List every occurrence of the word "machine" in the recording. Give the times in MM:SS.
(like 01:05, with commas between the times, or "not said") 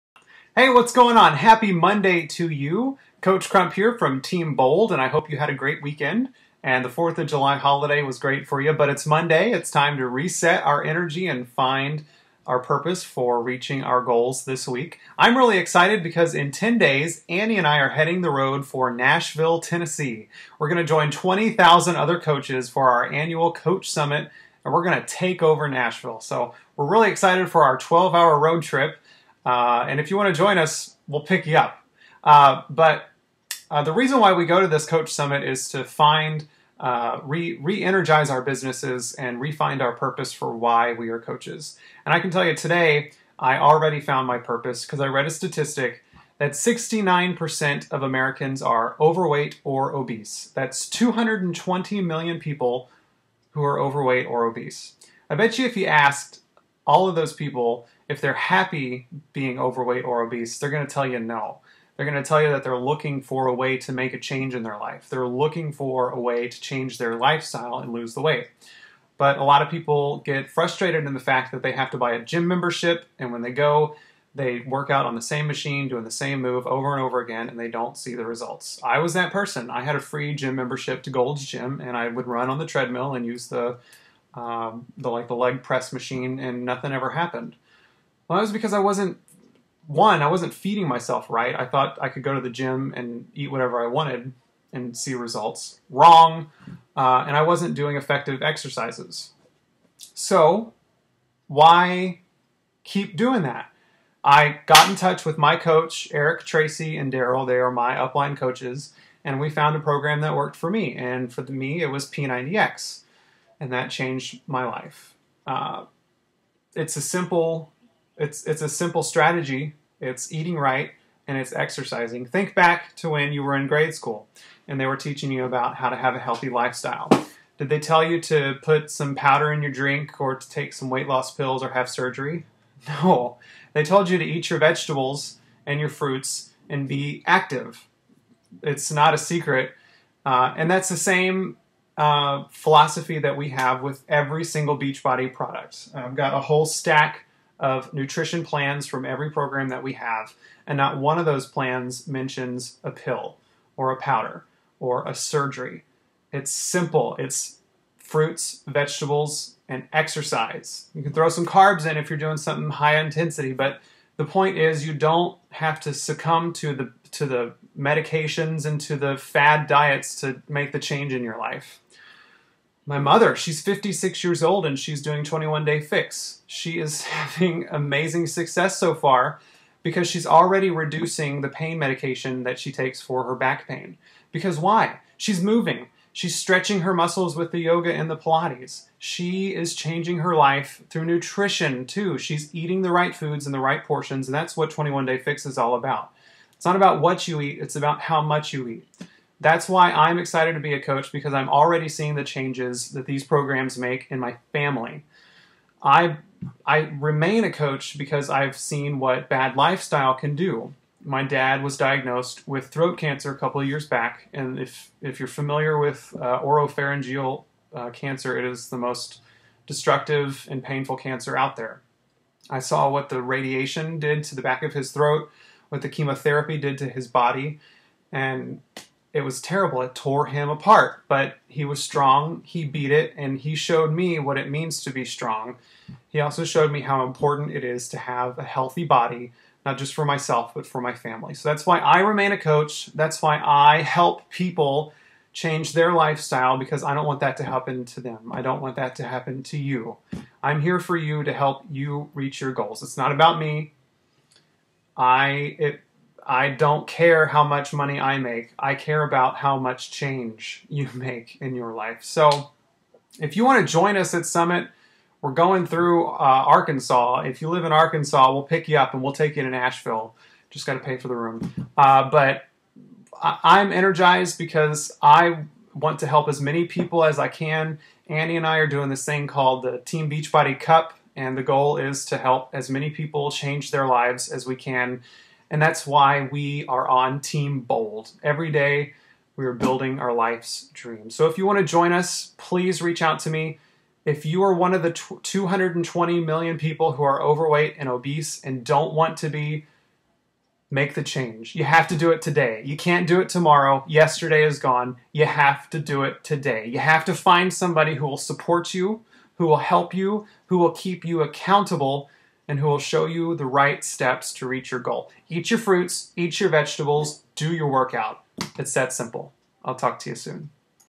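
01:15, 01:25.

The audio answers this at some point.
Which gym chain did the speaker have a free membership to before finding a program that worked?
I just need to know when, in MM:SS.
01:21.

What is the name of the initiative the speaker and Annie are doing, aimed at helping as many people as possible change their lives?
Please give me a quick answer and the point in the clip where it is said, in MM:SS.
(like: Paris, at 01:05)
Team Beachbody Cup, at 04:39.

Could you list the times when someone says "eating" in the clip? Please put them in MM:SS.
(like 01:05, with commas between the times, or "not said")
02:00, 03:12.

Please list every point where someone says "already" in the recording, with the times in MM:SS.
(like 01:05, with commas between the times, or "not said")
00:43, 03:00, 03:21.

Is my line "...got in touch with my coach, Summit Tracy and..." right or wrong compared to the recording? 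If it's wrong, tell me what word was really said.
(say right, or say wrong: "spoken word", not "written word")
wrong: "Eric", not "Summit".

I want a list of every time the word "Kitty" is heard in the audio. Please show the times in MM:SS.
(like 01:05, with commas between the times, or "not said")
not said.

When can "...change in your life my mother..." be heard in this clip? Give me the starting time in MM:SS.
02:50.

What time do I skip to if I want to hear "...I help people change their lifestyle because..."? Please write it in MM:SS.
04:03.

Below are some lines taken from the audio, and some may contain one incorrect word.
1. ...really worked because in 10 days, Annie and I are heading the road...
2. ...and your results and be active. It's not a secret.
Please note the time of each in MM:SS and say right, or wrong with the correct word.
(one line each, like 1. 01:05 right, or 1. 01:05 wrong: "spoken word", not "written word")
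1. 00:15 wrong: "excited", not "worked"
2. 02:15 wrong: "fruits", not "results".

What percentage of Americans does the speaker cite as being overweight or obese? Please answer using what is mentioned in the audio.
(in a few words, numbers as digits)
69%.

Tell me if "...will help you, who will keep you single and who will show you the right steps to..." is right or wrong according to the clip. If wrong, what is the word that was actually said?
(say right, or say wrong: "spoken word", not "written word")
wrong: "accountable", not "single".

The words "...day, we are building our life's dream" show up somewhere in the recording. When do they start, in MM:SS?
04:48.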